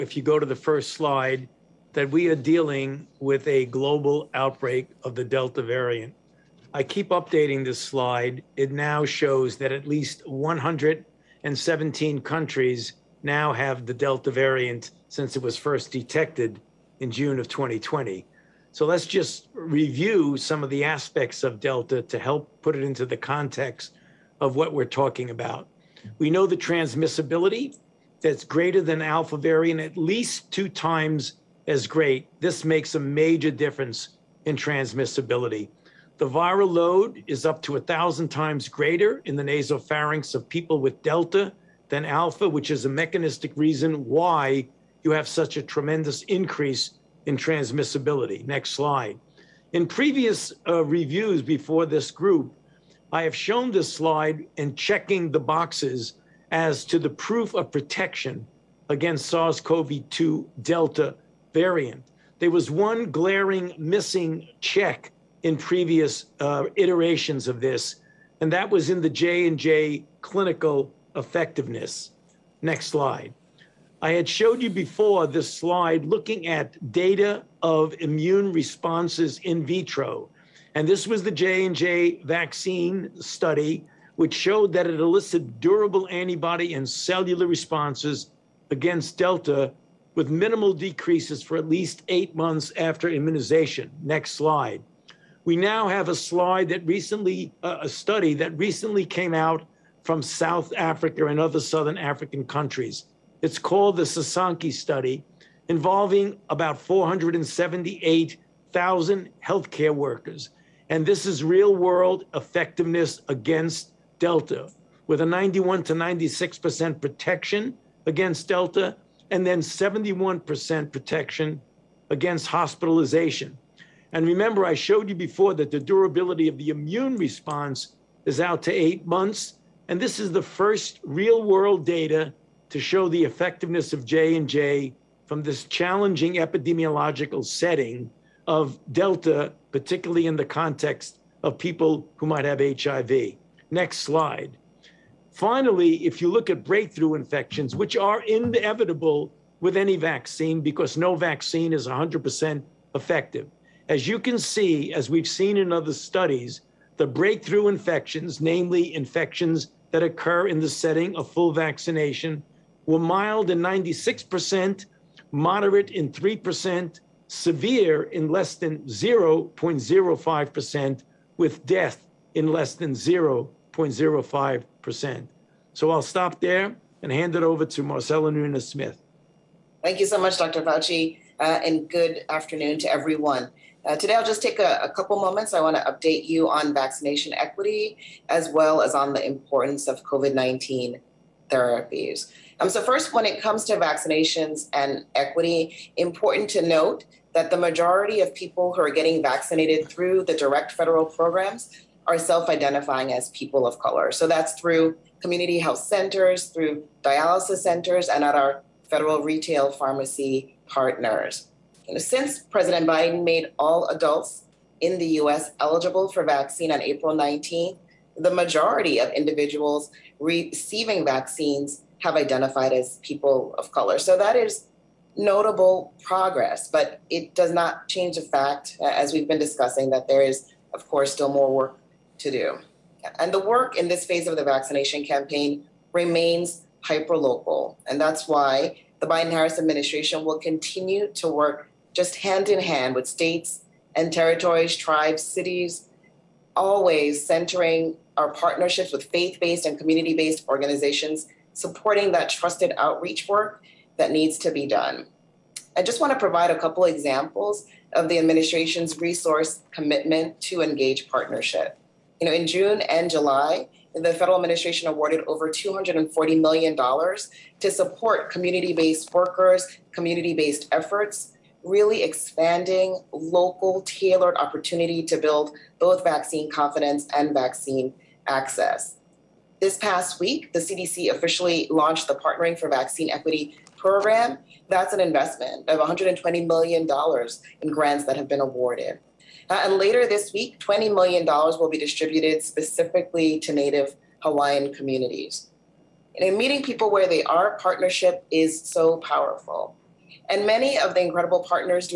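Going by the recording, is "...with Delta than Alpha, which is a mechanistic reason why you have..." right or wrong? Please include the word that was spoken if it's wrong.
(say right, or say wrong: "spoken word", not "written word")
right.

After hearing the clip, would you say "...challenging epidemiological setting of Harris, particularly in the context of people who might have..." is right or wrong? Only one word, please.
wrong.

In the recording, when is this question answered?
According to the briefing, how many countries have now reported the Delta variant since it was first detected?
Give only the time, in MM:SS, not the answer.
00:10.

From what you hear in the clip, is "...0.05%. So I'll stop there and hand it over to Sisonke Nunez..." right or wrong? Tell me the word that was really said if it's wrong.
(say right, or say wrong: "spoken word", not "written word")
wrong: "Marcella", not "Sisonke".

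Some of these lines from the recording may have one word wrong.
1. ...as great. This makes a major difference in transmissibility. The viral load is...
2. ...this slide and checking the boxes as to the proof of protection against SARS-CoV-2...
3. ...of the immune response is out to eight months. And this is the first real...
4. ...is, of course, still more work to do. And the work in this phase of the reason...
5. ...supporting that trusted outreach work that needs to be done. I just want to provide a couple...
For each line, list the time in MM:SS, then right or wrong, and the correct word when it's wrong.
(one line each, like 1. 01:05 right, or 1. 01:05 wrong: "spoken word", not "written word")
1. 00:31 right
2. 00:53 right
3. 02:06 right
4. 03:50 wrong: "vaccination", not "reason"
5. 04:11 right.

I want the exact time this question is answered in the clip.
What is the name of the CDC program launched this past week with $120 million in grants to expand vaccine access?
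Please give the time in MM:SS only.
04:42.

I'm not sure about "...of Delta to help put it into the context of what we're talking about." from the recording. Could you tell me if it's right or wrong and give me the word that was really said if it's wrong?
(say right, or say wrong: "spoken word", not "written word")
right.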